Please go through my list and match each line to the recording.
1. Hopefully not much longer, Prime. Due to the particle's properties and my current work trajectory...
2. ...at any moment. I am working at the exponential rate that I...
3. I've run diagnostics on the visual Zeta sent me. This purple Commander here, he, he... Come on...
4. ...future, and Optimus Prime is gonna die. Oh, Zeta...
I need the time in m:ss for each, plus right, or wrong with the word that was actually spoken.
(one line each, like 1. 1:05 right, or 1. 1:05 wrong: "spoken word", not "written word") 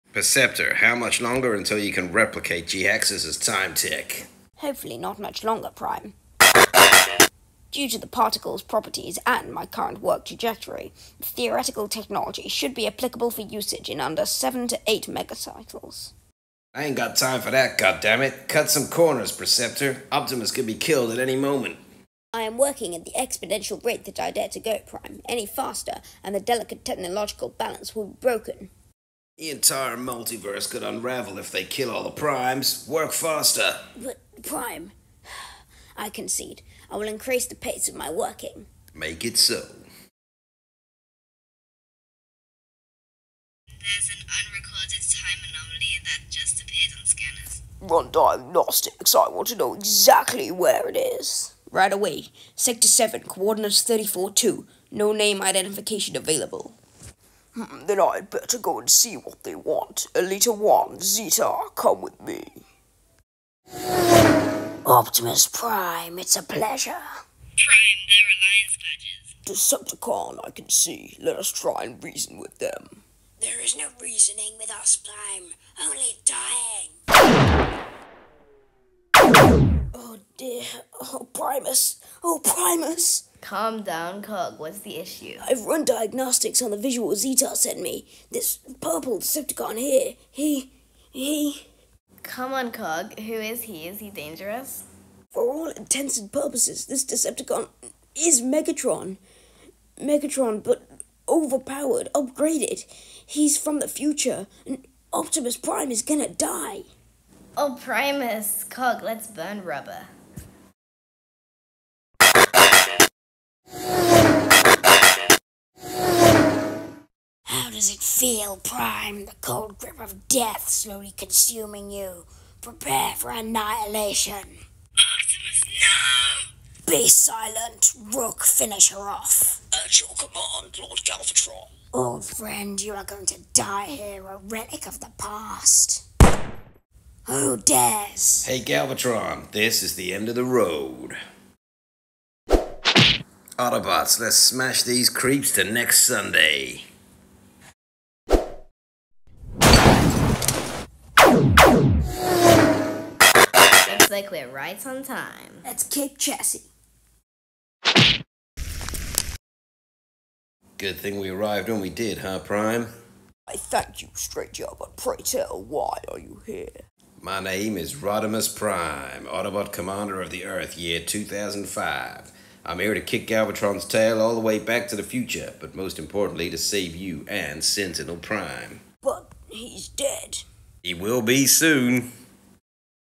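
1. 0:04 right
2. 0:21 right
3. 1:25 wrong: "Decepticon", not "Commander"
4. 1:43 wrong: "Primus", not "Zeta".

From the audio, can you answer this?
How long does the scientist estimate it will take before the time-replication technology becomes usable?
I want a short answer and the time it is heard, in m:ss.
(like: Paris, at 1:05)
7 to 8 megacycles, at 0:14.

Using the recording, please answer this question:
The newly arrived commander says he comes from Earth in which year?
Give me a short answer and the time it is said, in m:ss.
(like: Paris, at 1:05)
2005, at 2:50.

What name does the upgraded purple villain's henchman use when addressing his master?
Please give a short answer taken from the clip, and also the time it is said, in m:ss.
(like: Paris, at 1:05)
Lord Galvatron, at 2:10.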